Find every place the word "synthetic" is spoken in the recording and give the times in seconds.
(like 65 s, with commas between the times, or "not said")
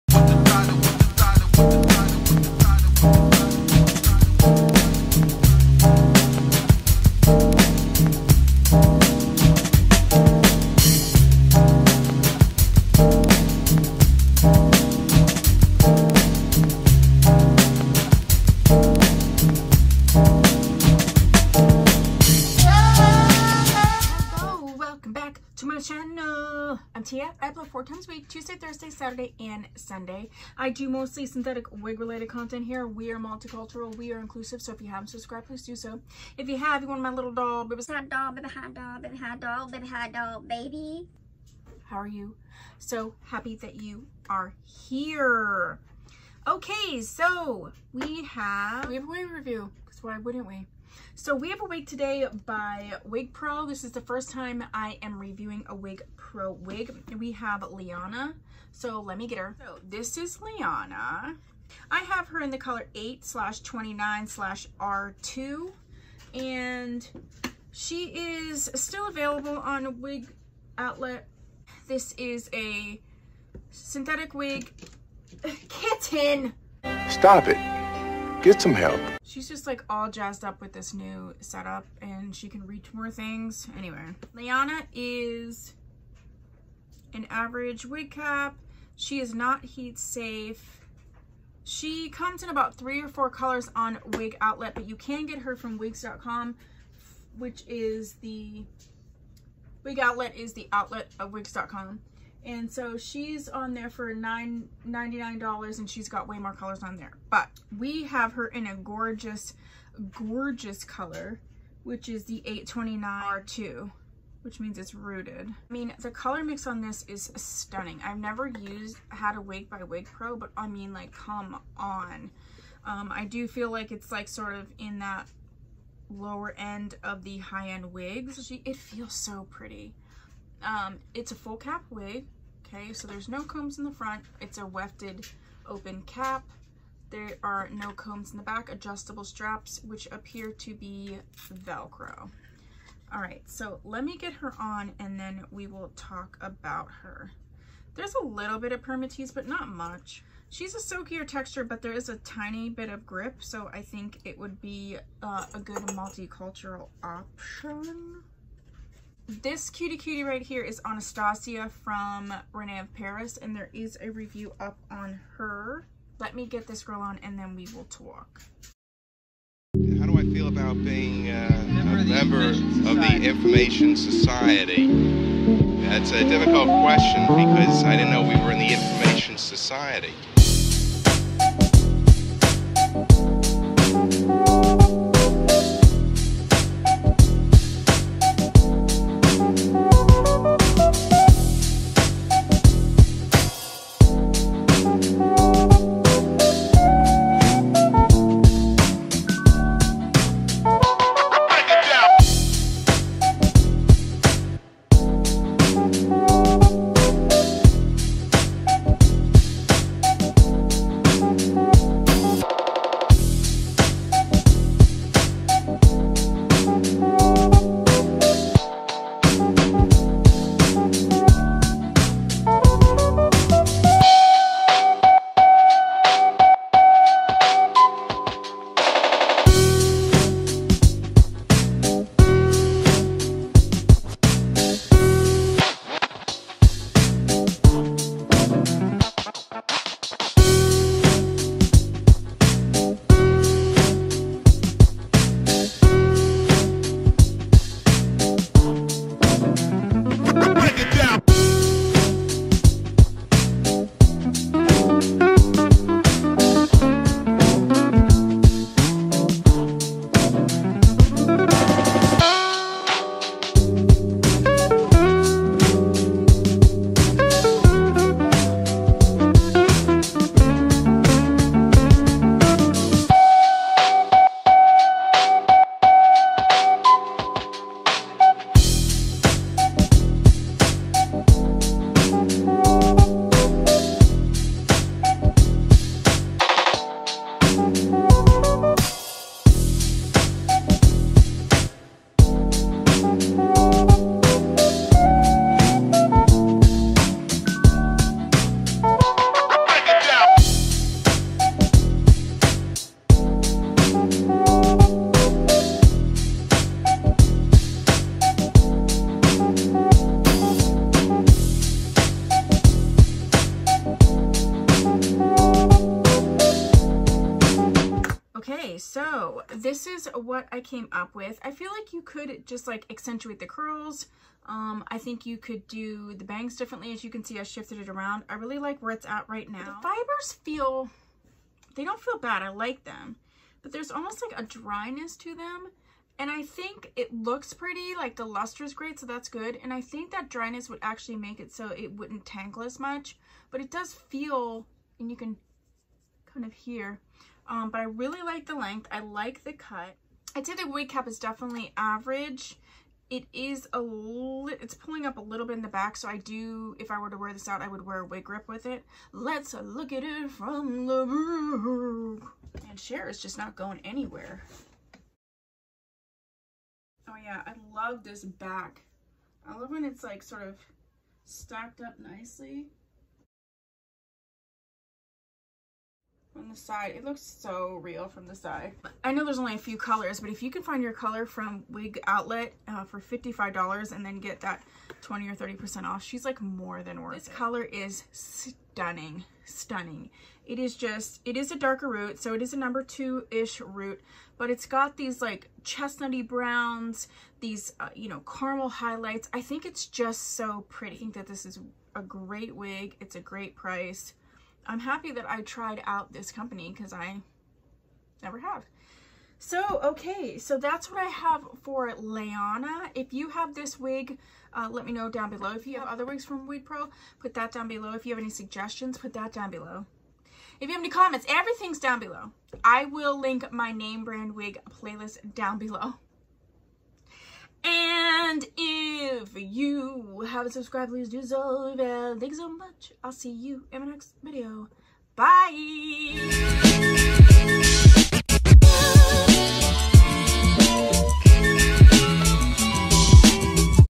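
31 s, 73 s.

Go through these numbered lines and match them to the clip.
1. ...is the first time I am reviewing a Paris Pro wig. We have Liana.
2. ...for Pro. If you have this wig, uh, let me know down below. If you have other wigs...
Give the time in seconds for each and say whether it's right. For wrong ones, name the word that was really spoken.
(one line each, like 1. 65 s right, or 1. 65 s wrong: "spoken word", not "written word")
1. 53 s wrong: "Wig", not "Paris"
2. 411 s wrong: "Liana", not "Pro".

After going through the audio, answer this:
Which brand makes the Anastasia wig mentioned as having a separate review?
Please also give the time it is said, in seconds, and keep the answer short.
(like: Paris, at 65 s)
René of Paris, at 162 s.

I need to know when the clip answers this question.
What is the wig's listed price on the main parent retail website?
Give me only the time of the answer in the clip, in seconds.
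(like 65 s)
104 s.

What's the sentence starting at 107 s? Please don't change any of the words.
But we have her in a gorgeous, gorgeous color, which is the 829 R2 which means it's rooted.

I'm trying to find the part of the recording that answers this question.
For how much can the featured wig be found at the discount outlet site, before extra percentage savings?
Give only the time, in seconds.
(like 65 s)
382 s.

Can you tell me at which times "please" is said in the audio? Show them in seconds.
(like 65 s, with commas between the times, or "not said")
35 s, 430 s.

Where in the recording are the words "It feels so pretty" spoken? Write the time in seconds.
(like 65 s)
128 s.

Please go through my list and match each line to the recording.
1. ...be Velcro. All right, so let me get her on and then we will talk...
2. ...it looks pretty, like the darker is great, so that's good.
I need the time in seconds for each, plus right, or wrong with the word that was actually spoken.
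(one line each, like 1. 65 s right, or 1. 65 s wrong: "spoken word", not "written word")
1. 140 s right
2. 336 s wrong: "luster", not "darker".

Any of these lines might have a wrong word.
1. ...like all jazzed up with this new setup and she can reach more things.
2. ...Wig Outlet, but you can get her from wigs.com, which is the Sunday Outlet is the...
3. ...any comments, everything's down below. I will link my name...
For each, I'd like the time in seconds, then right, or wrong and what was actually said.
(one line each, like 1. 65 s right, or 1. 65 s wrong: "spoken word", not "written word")
1. 79 s right
2. 94 s wrong: "Wig", not "Sunday"
3. 420 s right.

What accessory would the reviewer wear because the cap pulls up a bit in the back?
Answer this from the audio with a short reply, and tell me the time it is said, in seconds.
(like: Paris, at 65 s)
wig grip, at 358 s.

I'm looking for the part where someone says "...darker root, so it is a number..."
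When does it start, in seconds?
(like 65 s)
391 s.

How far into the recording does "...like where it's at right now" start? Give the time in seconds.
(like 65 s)
328 s.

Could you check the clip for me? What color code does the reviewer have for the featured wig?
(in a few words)
8/29/R2.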